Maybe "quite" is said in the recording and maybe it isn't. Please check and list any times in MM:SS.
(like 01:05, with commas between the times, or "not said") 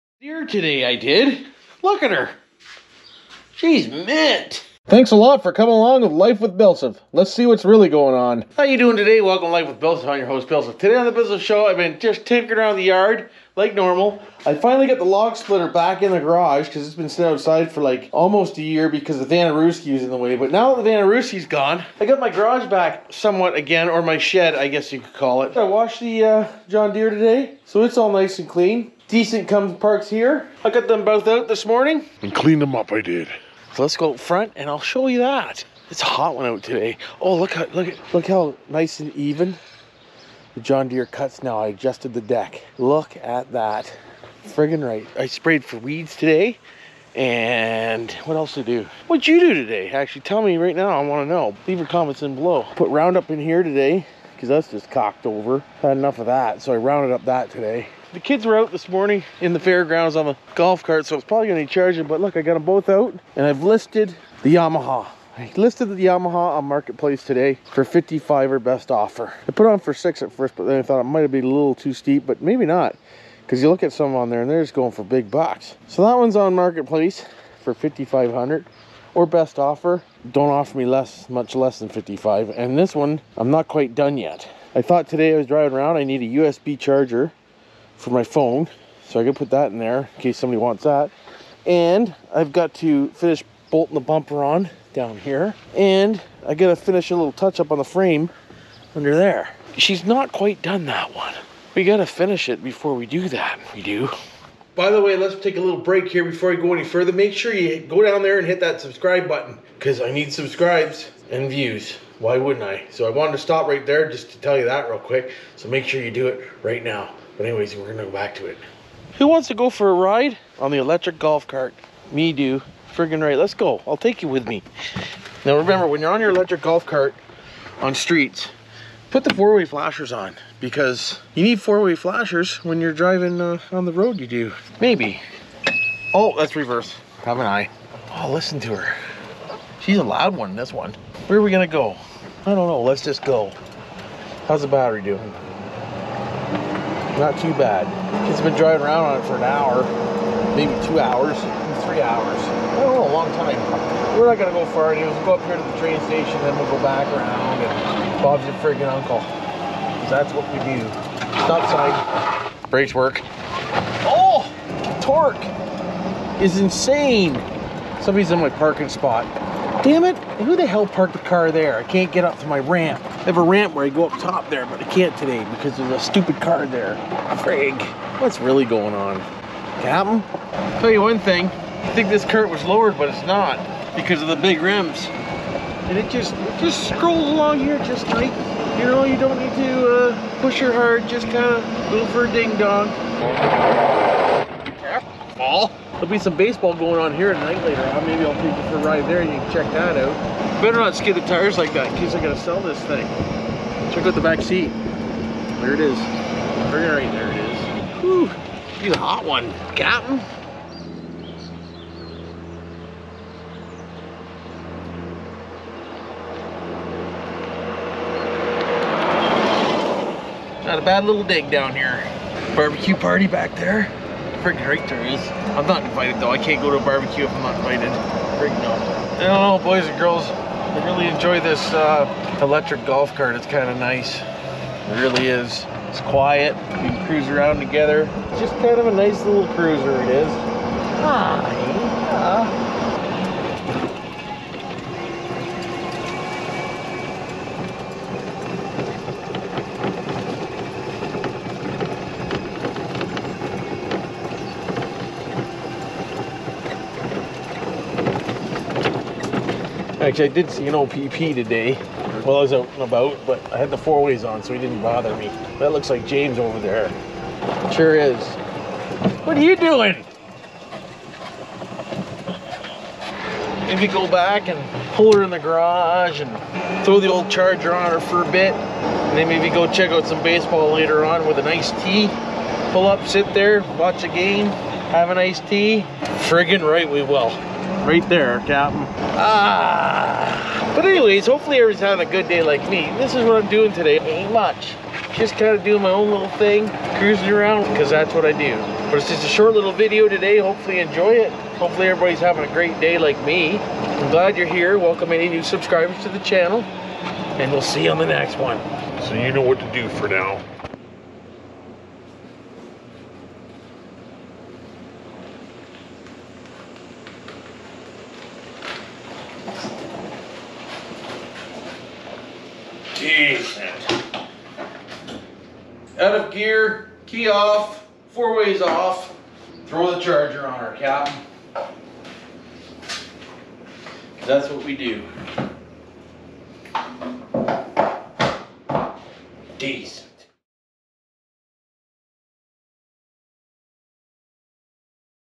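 01:23, 01:40.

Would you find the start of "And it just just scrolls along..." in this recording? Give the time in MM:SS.
03:05.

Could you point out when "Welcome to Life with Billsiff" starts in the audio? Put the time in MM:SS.
00:09.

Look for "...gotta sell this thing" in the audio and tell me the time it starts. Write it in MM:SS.
03:22.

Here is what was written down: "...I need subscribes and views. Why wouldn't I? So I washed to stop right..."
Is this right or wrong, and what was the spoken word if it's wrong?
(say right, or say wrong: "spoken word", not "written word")
wrong: "wanted", not "washed".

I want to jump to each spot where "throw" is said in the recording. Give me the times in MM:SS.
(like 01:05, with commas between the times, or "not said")
04:36, 05:29.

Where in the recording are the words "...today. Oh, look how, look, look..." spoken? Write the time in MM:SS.
00:36.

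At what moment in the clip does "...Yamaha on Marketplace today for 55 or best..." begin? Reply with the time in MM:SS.
01:06.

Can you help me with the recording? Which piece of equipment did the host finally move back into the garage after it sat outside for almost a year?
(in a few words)
Log splitter.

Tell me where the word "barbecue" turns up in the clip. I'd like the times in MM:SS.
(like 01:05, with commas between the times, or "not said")
03:42, 03:46.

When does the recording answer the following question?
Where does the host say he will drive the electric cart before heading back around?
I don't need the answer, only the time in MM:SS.
02:35.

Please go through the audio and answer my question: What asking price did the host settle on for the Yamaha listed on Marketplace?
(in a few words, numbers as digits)
5500.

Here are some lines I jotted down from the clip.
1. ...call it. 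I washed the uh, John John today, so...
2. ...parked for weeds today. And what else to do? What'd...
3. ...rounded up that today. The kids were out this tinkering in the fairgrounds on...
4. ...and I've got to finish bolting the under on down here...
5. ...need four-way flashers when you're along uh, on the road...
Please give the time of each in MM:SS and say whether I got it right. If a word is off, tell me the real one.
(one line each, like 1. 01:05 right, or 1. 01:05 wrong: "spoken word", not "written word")
1. 00:25 wrong: "Deere", not "John"
2. 00:45 wrong: "sprayed", not "parked"
3. 00:56 wrong: "morning", not "tinkering"
4. 01:31 wrong: "bumper", not "under"
5. 02:11 wrong: "driving", not "along".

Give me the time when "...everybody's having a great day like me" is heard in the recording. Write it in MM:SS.
05:01.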